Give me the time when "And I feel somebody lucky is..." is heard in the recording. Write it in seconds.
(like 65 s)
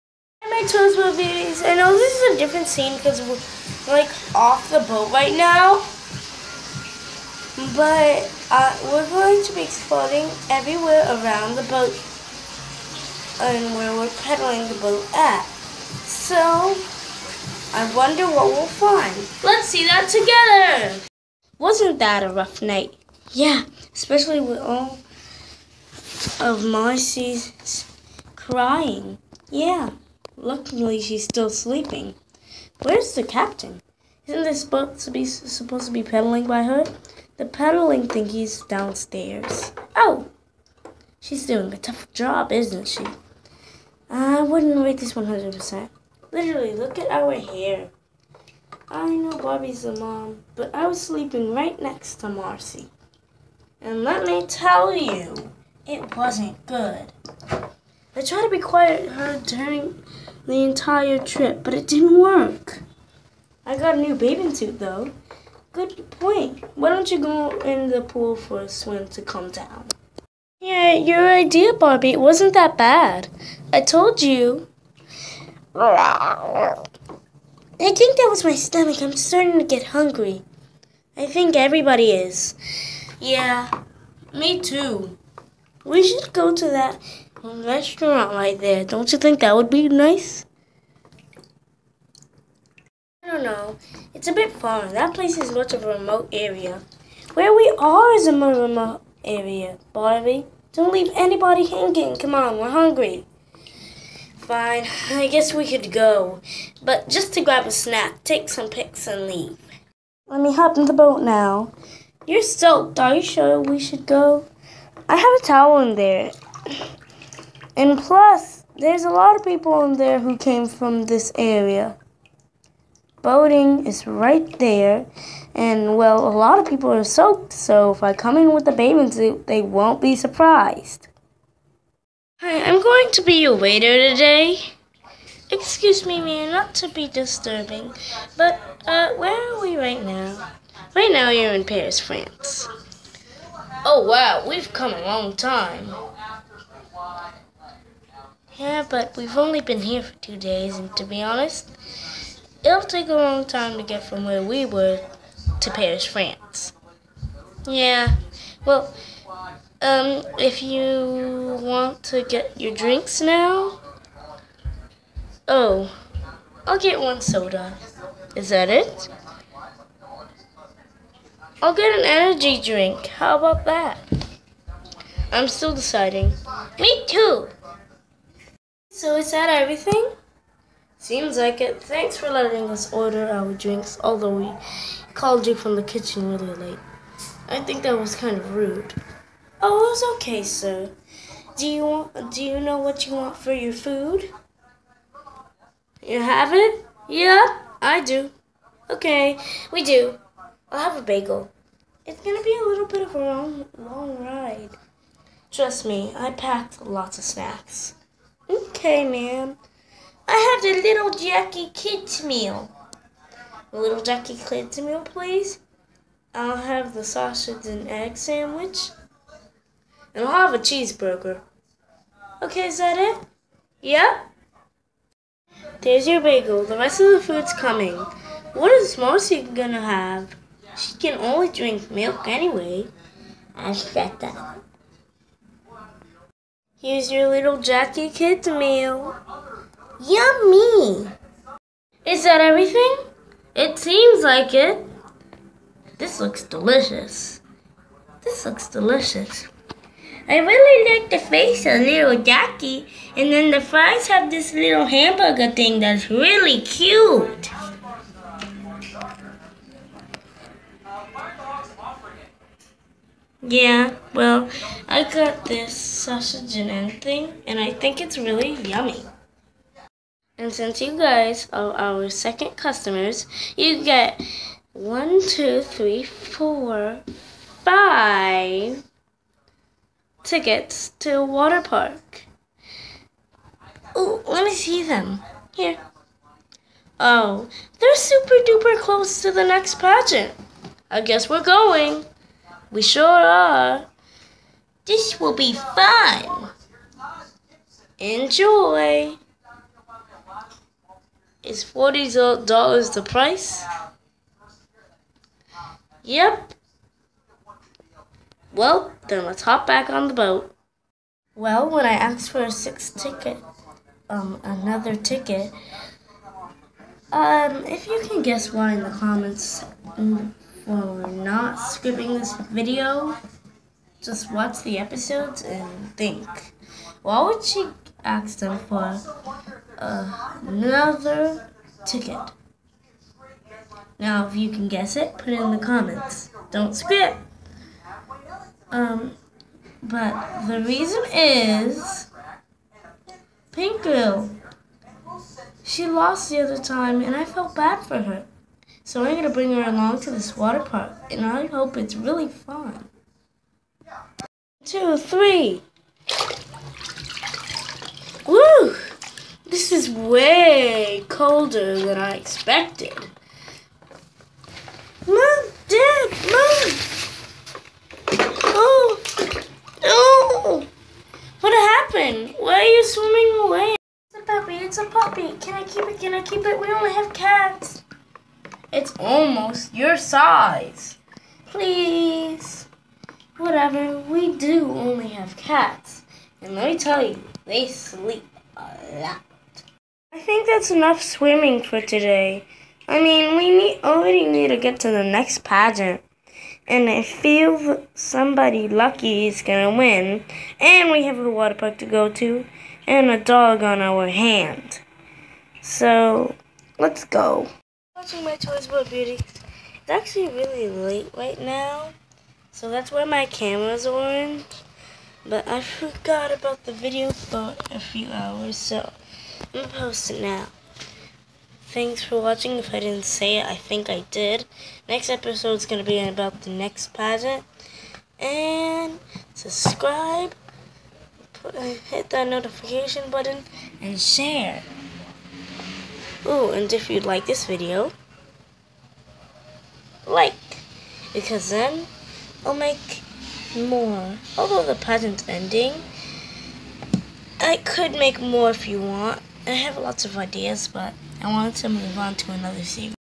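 396 s.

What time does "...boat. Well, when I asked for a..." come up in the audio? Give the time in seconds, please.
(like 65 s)
310 s.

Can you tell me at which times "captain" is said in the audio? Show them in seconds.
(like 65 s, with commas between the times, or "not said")
33 s.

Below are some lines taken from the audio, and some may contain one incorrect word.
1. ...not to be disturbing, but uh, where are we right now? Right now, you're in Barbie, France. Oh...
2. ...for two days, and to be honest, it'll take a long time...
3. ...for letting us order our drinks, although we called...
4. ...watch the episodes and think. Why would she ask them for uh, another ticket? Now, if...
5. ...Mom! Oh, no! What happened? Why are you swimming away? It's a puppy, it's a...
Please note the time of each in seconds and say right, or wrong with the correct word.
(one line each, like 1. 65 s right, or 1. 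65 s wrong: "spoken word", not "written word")
1. 136 s wrong: "Paris", not "Barbie"
2. 150 s right
3. 182 s right
4. 324 s right
5. 366 s right.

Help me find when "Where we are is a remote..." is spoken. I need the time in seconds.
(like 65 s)
97 s.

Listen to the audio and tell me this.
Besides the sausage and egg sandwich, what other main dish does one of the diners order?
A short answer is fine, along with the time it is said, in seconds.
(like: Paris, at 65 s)
Cheeseburger, at 220 s.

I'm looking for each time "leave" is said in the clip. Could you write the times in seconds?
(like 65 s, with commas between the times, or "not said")
100 s, 109 s.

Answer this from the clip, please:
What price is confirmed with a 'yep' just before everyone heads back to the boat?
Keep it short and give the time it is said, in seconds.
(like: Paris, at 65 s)
$40, at 301 s.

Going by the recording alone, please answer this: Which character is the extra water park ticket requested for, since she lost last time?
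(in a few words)
Pink Girl.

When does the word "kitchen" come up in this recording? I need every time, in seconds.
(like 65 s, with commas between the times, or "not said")
185 s.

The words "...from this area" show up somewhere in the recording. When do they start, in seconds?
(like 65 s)
120 s.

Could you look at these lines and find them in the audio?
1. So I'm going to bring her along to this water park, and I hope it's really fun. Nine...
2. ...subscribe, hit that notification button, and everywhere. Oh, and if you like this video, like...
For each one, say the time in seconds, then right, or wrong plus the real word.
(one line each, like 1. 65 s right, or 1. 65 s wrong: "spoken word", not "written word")
1. 348 s wrong: "Two", not "Nine"
2. 429 s wrong: "share", not "everywhere".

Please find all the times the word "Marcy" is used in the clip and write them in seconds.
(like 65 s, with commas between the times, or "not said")
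26 s, 52 s, 228 s.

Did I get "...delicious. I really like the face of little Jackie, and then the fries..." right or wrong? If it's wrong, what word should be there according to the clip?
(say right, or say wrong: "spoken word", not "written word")
right.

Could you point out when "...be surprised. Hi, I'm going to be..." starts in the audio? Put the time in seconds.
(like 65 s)
130 s.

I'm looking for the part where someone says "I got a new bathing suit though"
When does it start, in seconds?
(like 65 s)
63 s.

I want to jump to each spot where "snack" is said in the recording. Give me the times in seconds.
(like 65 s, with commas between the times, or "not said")
107 s, 207 s.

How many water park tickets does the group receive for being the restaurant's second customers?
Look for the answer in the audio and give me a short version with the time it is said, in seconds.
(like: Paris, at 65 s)
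5, at 277 s.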